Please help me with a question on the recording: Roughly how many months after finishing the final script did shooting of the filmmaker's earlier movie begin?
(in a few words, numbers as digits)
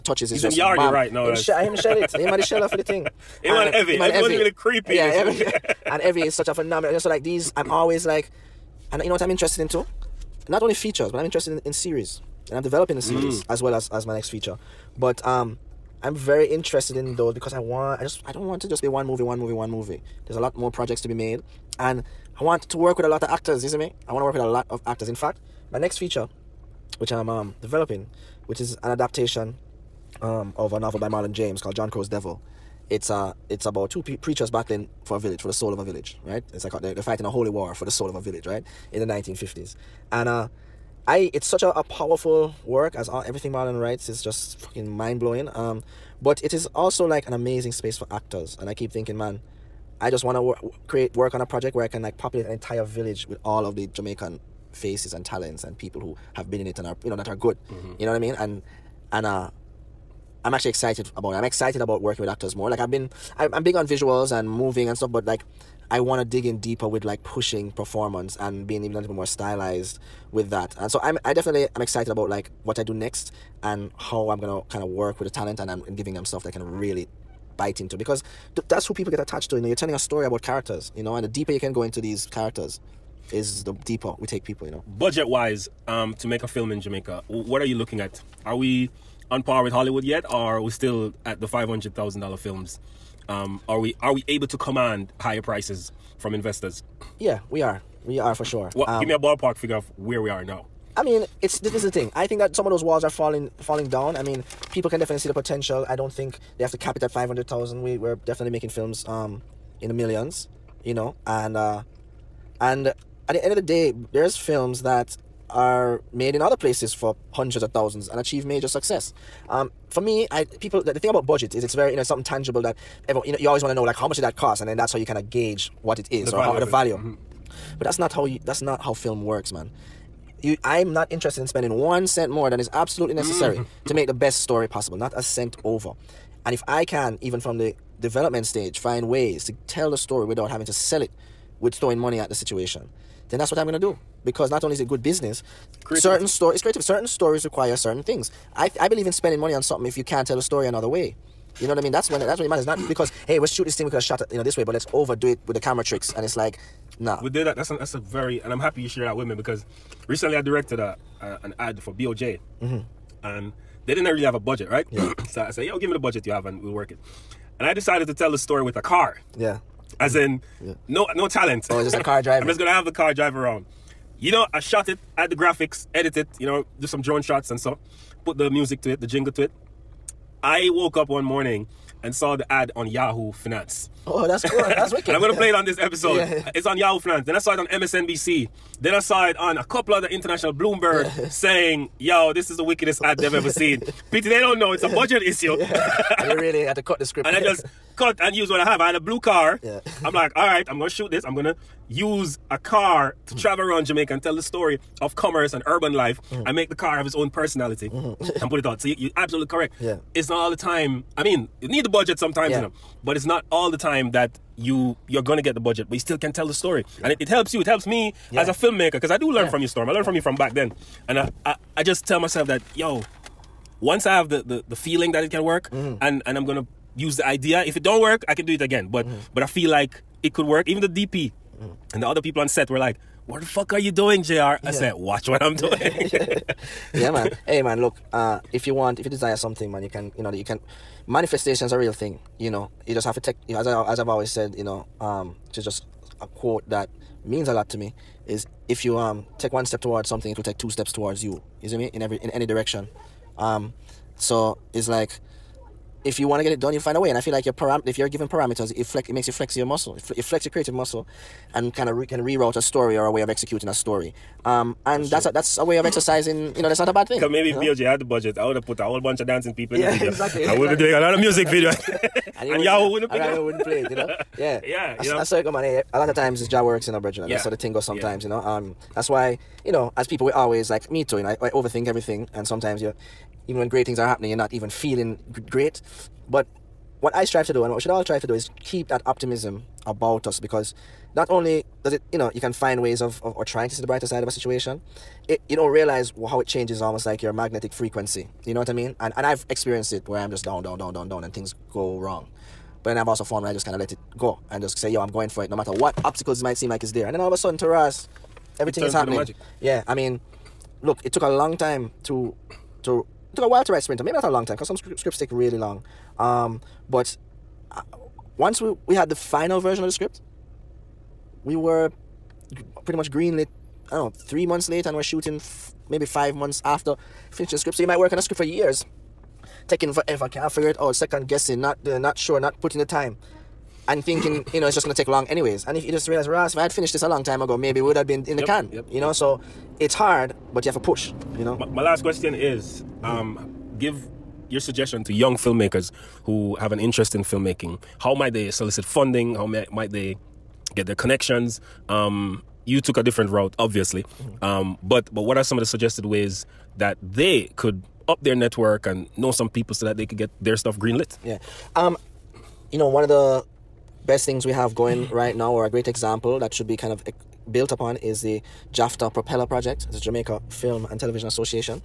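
5.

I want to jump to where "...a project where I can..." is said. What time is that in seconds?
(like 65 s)
51 s.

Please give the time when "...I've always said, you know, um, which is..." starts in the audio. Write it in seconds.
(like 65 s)
243 s.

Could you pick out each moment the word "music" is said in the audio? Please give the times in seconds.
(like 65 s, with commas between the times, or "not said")
178 s, 271 s.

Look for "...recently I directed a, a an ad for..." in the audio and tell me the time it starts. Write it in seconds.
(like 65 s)
160 s.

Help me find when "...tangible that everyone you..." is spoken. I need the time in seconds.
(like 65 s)
122 s.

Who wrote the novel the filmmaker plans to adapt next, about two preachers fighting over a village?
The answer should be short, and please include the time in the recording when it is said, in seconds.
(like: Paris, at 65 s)
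Marlon James, at 31 s.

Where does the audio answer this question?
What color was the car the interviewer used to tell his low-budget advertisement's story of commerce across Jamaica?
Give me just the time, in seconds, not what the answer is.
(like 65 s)
198 s.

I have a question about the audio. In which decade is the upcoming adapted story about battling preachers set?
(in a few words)
1950s.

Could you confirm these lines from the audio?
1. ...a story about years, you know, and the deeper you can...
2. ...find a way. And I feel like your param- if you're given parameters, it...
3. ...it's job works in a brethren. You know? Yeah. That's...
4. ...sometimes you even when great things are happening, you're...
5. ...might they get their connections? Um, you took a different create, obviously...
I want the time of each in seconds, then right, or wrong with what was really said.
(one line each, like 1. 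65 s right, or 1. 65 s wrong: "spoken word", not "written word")
1. 79 s wrong: "characters", not "years"
2. 256 s right
3. 276 s right
4. 282 s right
5. 349 s wrong: "route", not "create".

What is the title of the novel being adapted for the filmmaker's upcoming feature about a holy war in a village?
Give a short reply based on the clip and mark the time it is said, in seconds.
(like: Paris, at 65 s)
John Crow's Devil, at 31 s.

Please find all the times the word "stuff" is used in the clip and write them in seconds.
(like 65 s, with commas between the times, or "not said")
64 s, 76 s, 360 s.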